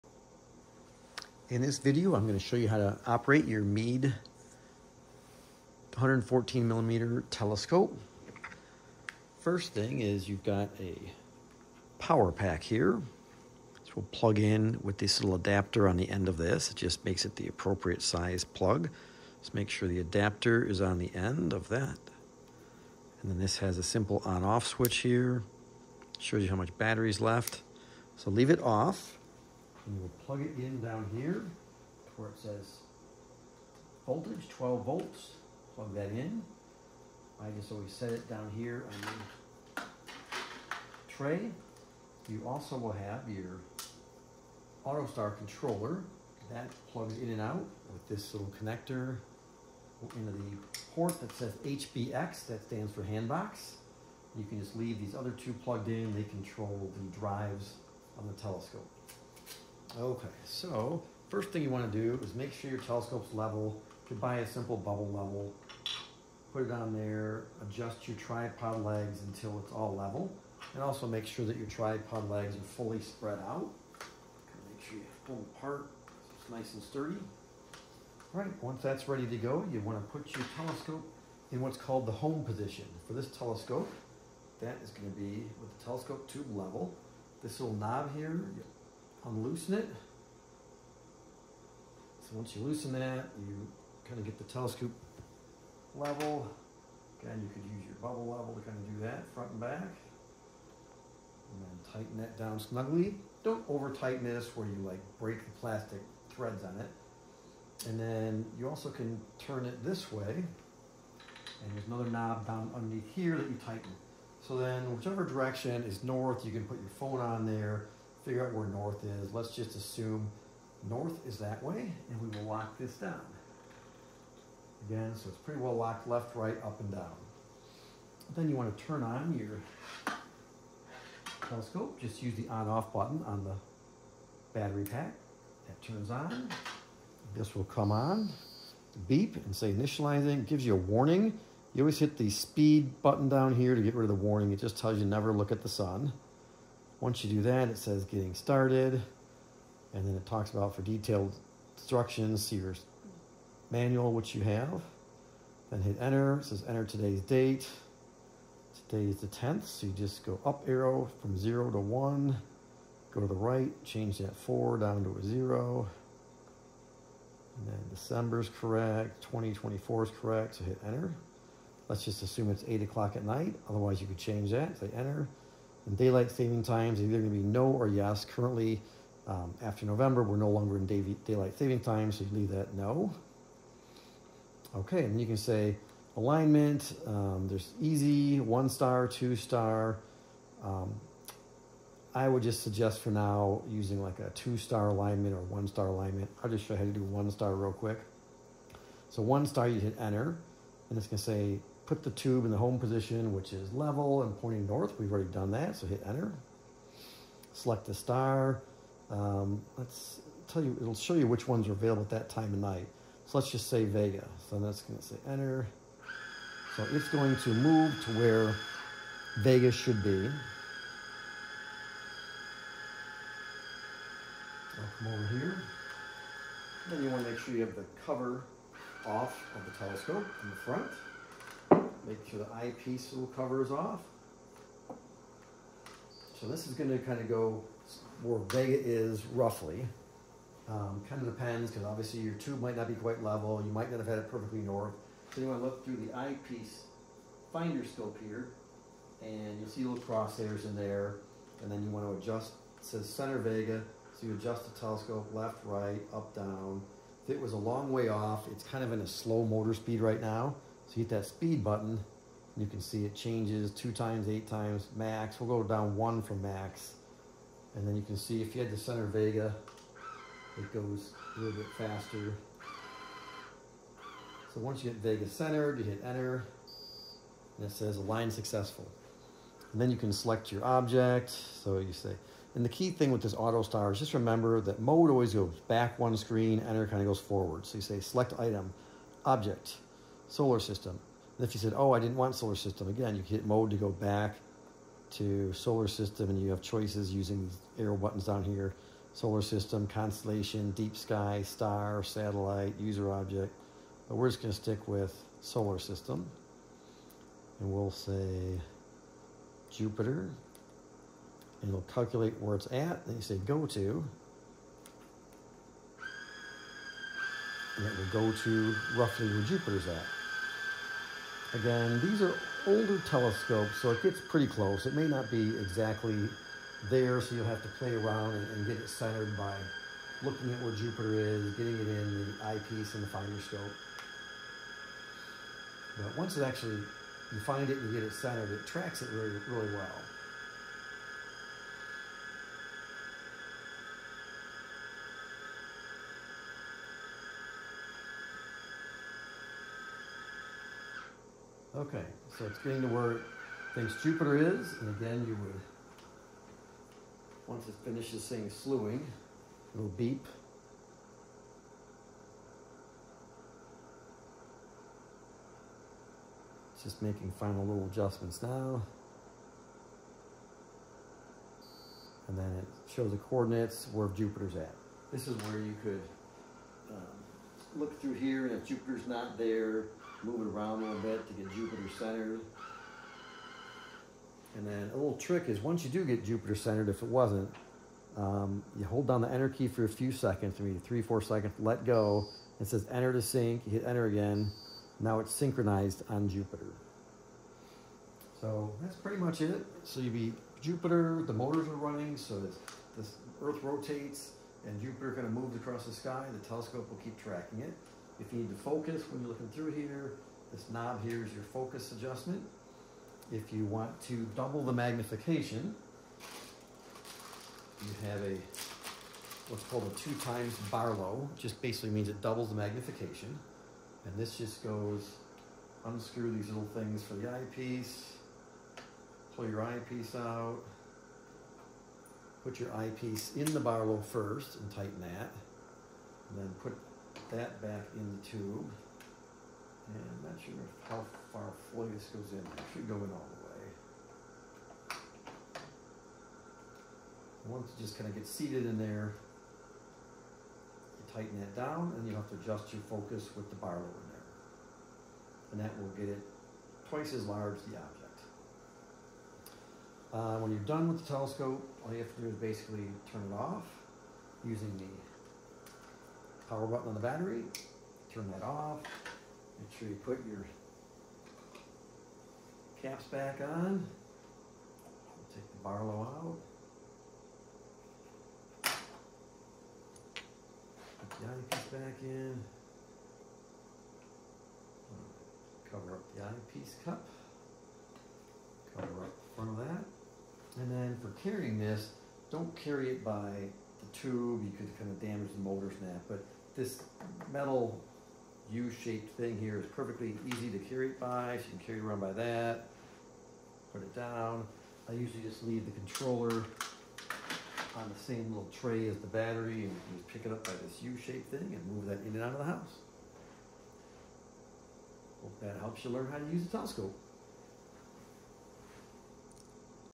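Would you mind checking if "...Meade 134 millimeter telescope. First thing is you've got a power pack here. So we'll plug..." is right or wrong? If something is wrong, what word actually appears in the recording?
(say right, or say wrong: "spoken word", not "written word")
wrong: "114", not "134".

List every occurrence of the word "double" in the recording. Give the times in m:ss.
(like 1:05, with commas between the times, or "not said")
6:54, 7:02.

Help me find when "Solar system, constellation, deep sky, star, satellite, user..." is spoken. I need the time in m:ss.
4:59.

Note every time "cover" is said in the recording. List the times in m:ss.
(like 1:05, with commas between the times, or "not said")
3:48, 3:53, 8:05.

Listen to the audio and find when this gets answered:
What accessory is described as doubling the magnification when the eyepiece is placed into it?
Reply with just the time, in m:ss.
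6:59.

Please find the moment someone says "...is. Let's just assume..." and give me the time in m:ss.
1:59.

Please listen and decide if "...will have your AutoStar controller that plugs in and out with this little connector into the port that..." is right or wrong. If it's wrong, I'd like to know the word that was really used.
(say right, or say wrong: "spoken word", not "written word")
right.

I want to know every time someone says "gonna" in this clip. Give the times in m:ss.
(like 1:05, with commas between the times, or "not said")
3:21, 3:56.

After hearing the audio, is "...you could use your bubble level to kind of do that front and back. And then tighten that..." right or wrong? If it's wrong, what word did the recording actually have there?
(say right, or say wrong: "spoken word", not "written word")
right.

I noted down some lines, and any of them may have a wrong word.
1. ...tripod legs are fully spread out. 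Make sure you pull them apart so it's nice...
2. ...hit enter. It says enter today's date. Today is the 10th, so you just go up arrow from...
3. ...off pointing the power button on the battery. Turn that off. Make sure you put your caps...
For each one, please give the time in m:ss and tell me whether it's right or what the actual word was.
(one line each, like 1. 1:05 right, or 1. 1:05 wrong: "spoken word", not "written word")
1. 1:11 right
2. 2:35 right
3. 7:43 wrong: "using", not "pointing".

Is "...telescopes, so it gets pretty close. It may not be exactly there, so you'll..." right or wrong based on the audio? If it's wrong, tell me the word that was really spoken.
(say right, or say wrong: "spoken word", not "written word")
right.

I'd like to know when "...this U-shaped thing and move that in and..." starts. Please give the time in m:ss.
8:30.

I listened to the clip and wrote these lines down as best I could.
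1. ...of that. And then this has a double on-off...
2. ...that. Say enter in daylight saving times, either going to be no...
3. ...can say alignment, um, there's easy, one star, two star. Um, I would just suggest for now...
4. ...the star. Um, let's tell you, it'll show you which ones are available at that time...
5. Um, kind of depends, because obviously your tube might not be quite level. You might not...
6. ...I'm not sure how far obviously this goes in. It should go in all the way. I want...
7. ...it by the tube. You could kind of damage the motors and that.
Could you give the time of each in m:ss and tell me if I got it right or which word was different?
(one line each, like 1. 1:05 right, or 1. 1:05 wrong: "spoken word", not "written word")
1. 0:21 wrong: "simple", not "double"
2. 2:54 right
3. 3:05 right
4. 3:27 right
5. 4:00 right
6. 7:20 wrong: "fully", not "obviously"
7. 8:12 right.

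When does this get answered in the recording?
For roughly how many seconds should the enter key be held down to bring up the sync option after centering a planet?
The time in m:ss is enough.
6:30.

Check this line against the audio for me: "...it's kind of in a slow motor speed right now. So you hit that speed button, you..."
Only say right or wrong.
right.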